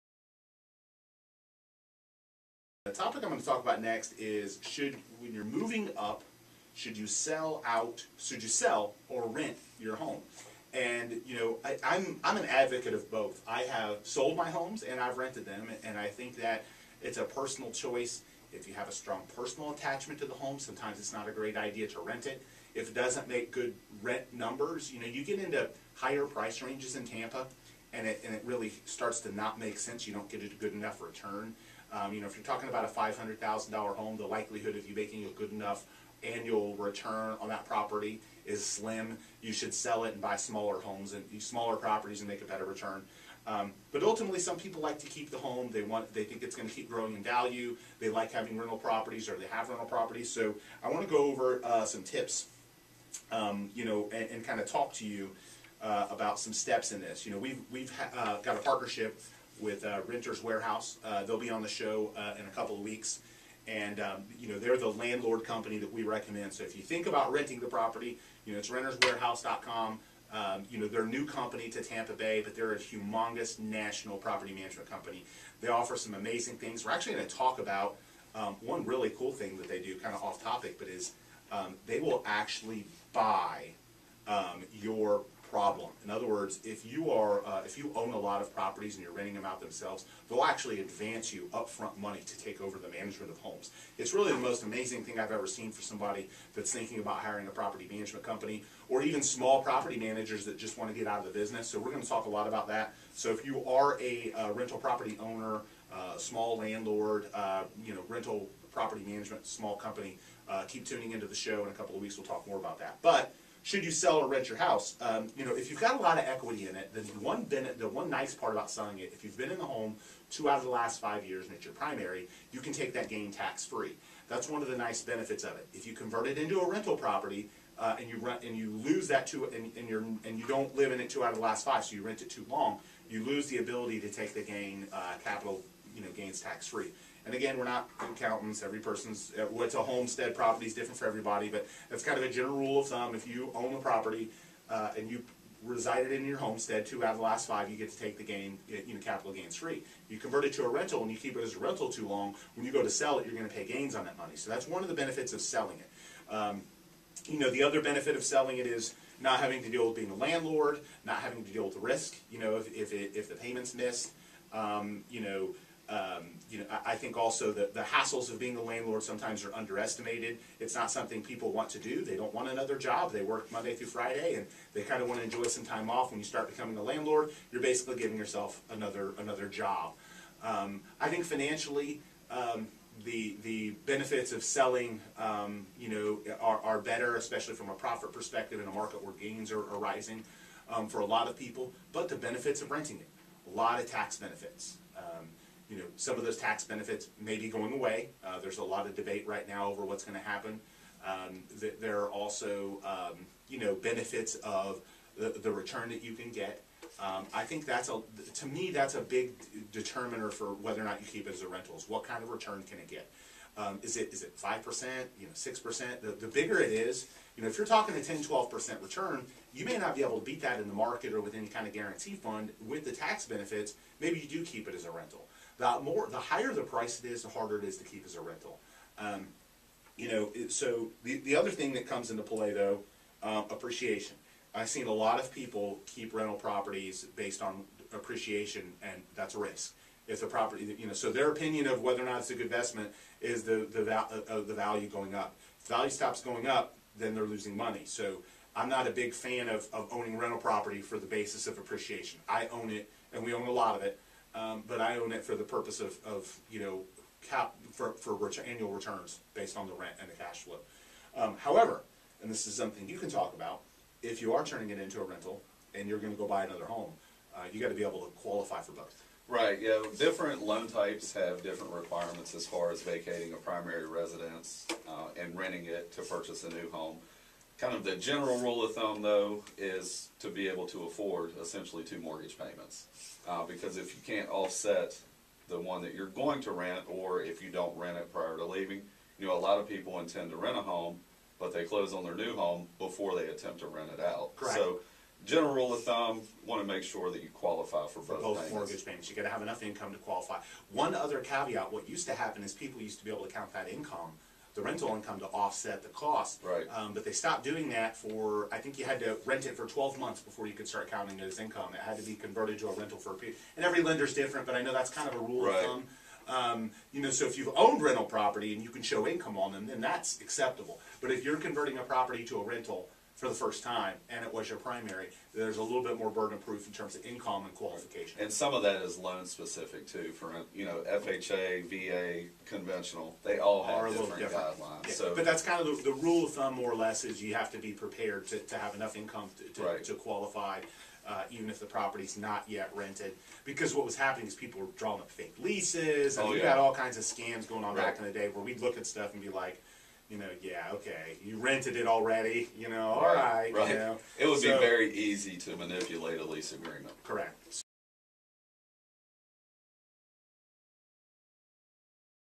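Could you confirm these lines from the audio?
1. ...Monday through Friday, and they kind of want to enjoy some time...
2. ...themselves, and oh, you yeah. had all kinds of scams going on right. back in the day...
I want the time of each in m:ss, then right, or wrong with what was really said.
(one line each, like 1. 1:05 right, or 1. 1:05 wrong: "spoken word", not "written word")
1. 2:53 right
2. 5:45 wrong: "leases", not "themselves".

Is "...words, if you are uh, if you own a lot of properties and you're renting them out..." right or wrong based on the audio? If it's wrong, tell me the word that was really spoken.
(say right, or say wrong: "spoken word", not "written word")
right.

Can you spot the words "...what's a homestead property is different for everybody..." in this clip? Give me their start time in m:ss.
2:19.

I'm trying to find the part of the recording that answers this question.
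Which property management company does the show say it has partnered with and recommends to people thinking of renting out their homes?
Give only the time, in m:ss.
1:00.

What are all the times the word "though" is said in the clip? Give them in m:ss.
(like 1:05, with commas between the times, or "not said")
3:52, 4:39.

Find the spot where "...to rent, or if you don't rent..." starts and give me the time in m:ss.
4:46.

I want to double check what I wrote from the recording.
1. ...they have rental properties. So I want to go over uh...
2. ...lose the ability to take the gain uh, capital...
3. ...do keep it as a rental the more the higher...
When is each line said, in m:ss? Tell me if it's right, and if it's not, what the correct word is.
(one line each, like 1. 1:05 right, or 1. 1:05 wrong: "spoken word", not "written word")
1. 0:49 right
2. 2:13 right
3. 3:44 right.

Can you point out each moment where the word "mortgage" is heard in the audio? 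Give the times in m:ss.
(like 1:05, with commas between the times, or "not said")
4:41, 4:58.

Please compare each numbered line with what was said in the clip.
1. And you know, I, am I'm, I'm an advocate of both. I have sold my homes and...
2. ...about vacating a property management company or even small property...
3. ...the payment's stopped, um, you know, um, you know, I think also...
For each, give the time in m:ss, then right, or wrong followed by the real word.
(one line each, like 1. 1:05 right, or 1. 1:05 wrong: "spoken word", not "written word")
1. 0:10 right
2. 1:36 wrong: "hiring", not "vacating"
3. 2:43 wrong: "missed", not "stopped".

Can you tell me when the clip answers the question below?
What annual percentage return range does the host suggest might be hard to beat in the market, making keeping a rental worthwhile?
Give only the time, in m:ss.
3:38.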